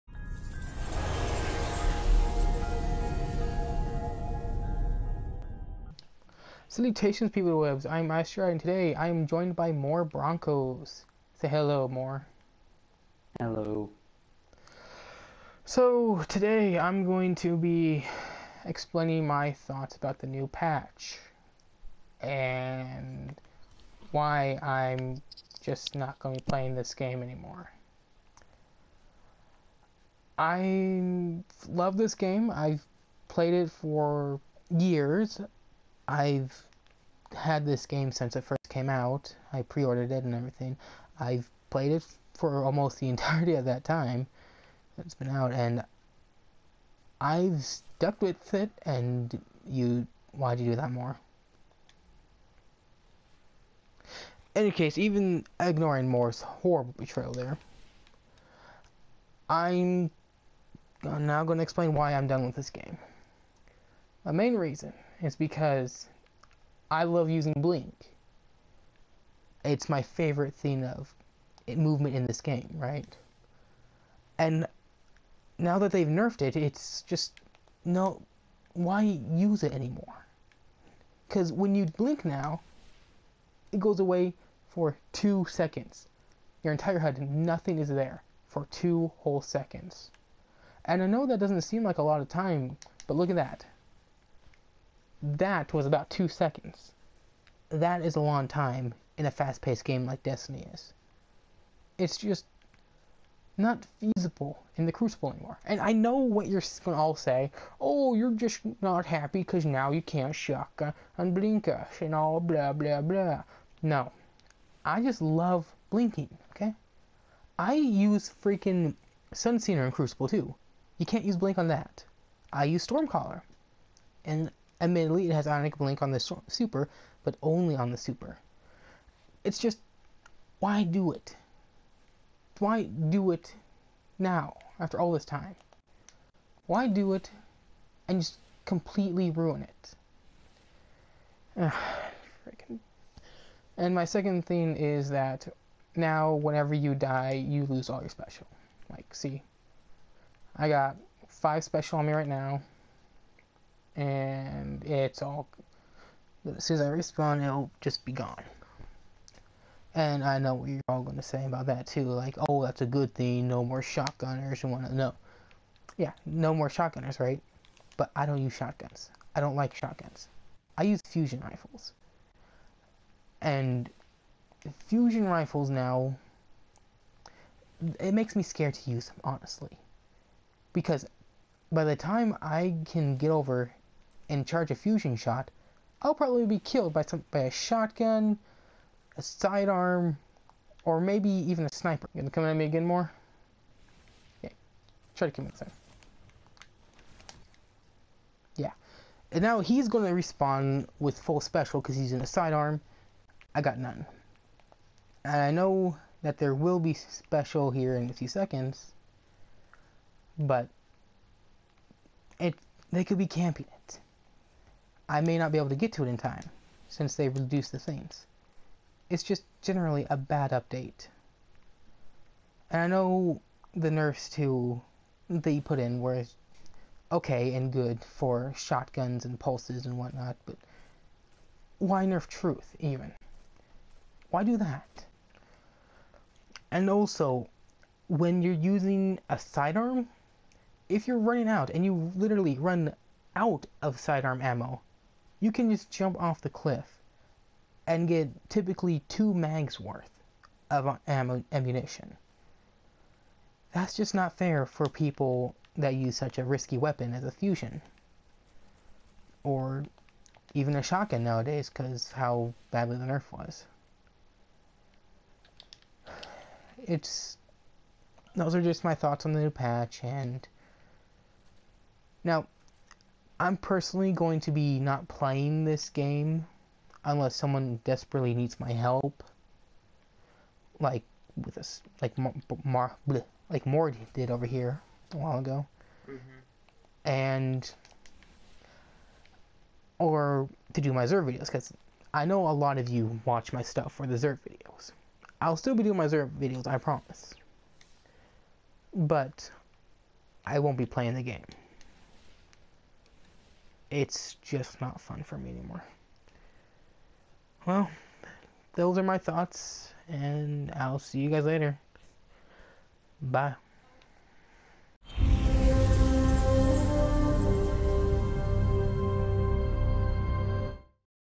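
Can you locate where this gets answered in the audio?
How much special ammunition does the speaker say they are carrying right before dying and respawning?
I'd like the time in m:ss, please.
2:31.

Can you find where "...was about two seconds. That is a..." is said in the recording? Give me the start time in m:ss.
1:35.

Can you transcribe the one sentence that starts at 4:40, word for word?
Like with us, like Mar, Mar like Mord did over here a while ago, mm -hmm.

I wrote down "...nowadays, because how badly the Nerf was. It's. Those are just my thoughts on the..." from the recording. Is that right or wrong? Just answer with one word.
right.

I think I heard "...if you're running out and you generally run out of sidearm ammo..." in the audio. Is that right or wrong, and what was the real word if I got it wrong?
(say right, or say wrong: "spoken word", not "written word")
wrong: "literally", not "generally".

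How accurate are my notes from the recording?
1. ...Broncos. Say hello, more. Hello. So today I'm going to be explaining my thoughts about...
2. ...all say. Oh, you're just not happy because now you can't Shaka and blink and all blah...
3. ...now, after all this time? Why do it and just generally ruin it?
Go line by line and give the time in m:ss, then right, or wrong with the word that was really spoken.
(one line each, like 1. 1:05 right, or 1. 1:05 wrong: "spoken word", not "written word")
1. 0:10 right
2. 1:47 right
3. 2:14 wrong: "completely", not "generally".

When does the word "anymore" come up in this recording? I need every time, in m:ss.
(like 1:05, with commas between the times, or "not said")
0:27, 1:19, 1:45, 5:05.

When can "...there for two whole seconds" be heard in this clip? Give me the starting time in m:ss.
1:27.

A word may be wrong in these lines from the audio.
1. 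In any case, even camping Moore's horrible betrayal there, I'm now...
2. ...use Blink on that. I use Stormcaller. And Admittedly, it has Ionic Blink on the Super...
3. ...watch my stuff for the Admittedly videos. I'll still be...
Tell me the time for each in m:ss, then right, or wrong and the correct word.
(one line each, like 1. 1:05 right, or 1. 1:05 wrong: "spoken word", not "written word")
1. 0:54 wrong: "ignoring", not "camping"
2. 2:01 right
3. 4:53 wrong: "Zerg", not "Admittedly".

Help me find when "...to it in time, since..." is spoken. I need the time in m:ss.
3:35.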